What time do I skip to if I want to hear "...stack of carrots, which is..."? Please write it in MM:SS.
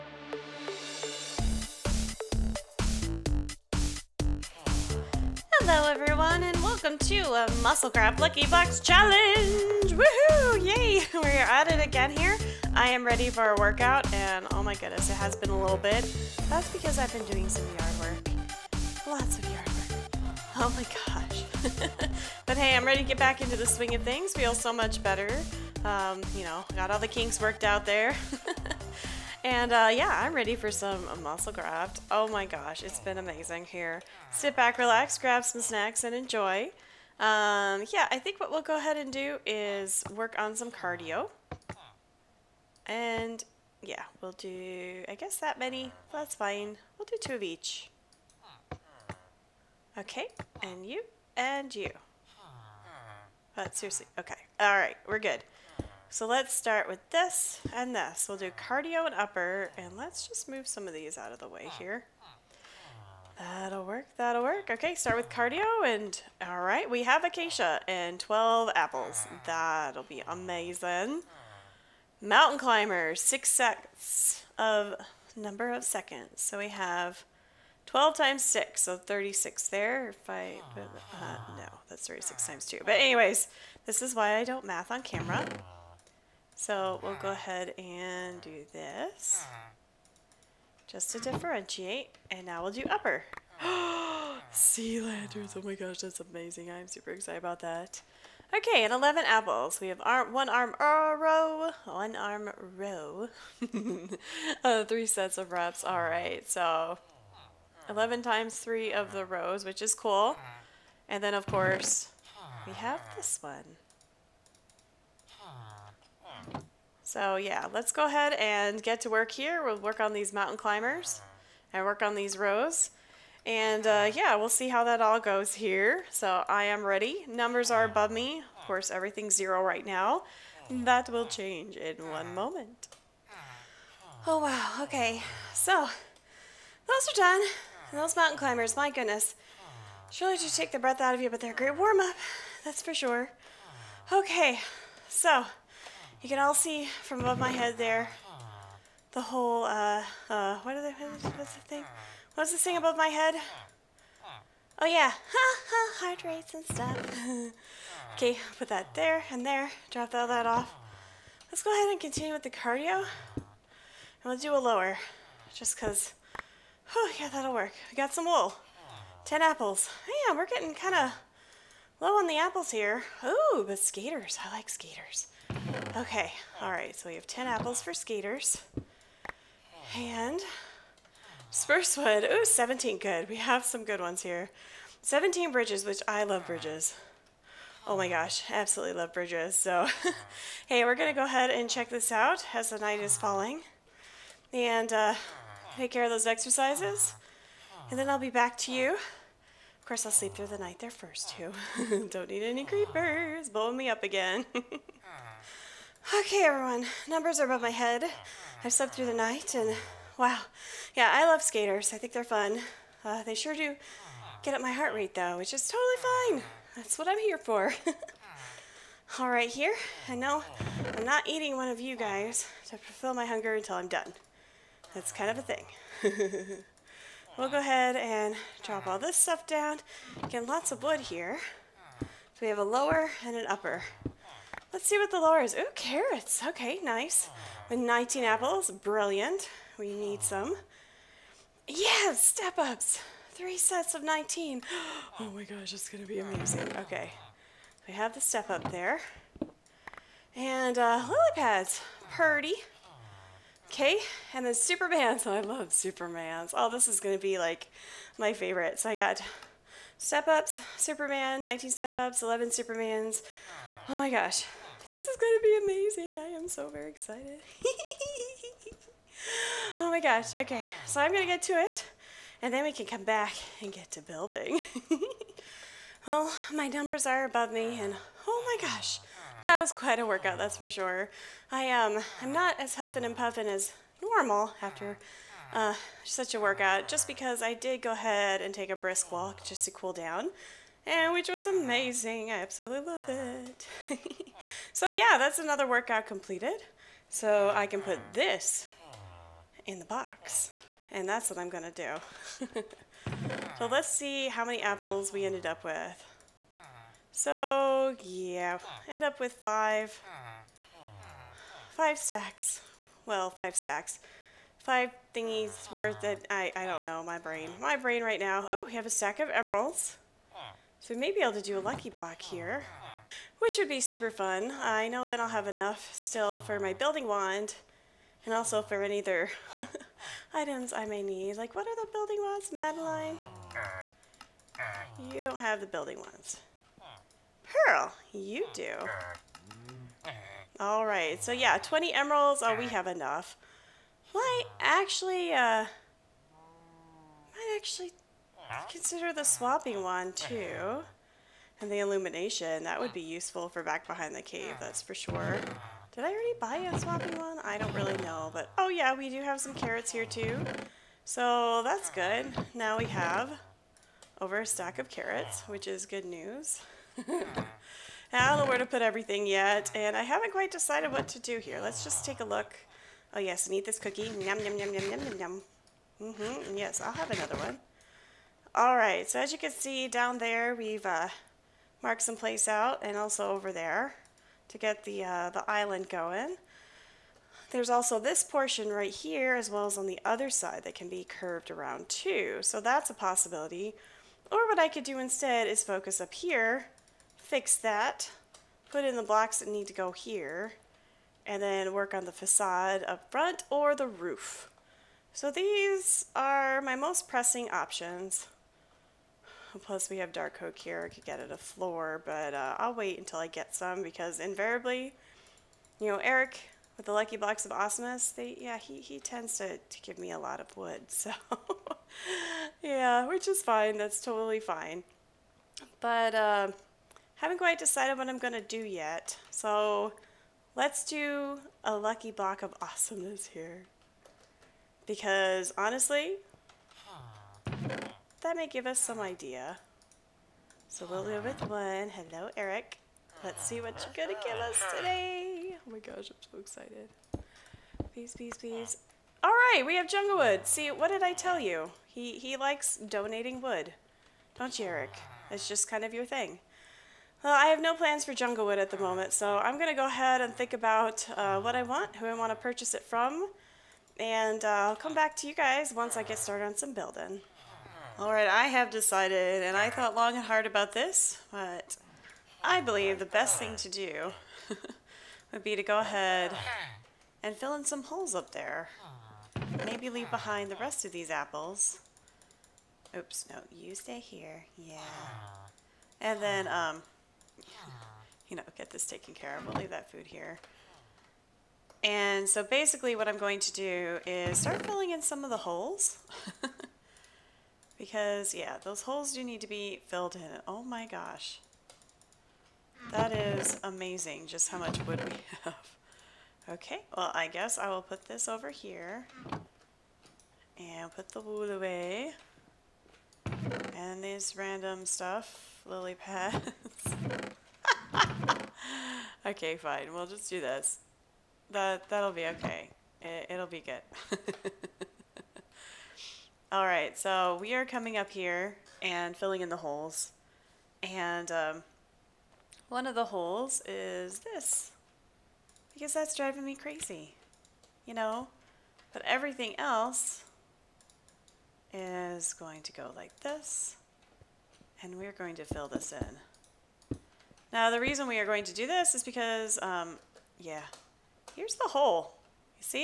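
06:04.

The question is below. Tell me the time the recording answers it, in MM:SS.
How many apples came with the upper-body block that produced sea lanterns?
01:38.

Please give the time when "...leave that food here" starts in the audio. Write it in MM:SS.
08:09.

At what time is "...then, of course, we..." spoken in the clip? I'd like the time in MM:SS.
01:51.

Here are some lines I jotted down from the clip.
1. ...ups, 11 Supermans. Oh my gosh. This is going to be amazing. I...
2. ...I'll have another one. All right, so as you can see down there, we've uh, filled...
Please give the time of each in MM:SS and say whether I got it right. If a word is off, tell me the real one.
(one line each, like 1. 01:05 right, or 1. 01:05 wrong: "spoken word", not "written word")
1. 04:21 right
2. 06:16 wrong: "marked", not "filled".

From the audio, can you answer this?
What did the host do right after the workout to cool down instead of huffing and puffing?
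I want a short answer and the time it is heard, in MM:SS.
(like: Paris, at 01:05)
A brisk walk, at 04:48.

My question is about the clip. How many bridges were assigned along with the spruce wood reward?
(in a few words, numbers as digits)
17.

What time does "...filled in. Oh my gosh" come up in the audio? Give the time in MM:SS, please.
08:19.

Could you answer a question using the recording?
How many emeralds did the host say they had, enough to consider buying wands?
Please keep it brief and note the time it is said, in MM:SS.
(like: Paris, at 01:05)
20, at 05:41.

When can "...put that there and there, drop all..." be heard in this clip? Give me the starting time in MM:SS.
02:38.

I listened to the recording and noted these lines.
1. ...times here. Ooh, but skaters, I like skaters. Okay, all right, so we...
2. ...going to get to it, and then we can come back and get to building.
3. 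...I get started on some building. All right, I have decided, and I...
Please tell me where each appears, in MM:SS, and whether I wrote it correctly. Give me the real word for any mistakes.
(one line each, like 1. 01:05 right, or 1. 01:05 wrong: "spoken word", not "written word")
1. 02:52 wrong: "apples", not "times"
2. 04:31 right
3. 07:45 right.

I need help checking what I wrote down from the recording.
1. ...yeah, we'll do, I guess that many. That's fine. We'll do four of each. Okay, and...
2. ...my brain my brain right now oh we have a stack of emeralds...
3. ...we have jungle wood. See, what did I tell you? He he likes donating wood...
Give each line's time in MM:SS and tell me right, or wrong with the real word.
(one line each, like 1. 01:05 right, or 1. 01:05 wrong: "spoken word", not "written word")
1. 00:43 wrong: "two", not "four"
2. 05:17 right
3. 07:29 right.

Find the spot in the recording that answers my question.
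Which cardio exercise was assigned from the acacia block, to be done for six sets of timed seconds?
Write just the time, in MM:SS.
01:12.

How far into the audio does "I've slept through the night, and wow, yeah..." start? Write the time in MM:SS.
03:28.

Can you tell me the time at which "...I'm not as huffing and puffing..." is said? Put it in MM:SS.
04:42.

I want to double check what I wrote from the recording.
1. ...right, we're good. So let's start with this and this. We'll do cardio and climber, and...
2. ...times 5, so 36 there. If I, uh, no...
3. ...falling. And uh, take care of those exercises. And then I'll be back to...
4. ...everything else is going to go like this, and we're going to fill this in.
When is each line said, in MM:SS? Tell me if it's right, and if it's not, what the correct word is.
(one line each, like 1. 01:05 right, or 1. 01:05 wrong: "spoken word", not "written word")
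1. 00:54 wrong: "upper", not "climber"
2. 01:18 wrong: "6", not "5"
3. 03:13 right
4. 08:59 right.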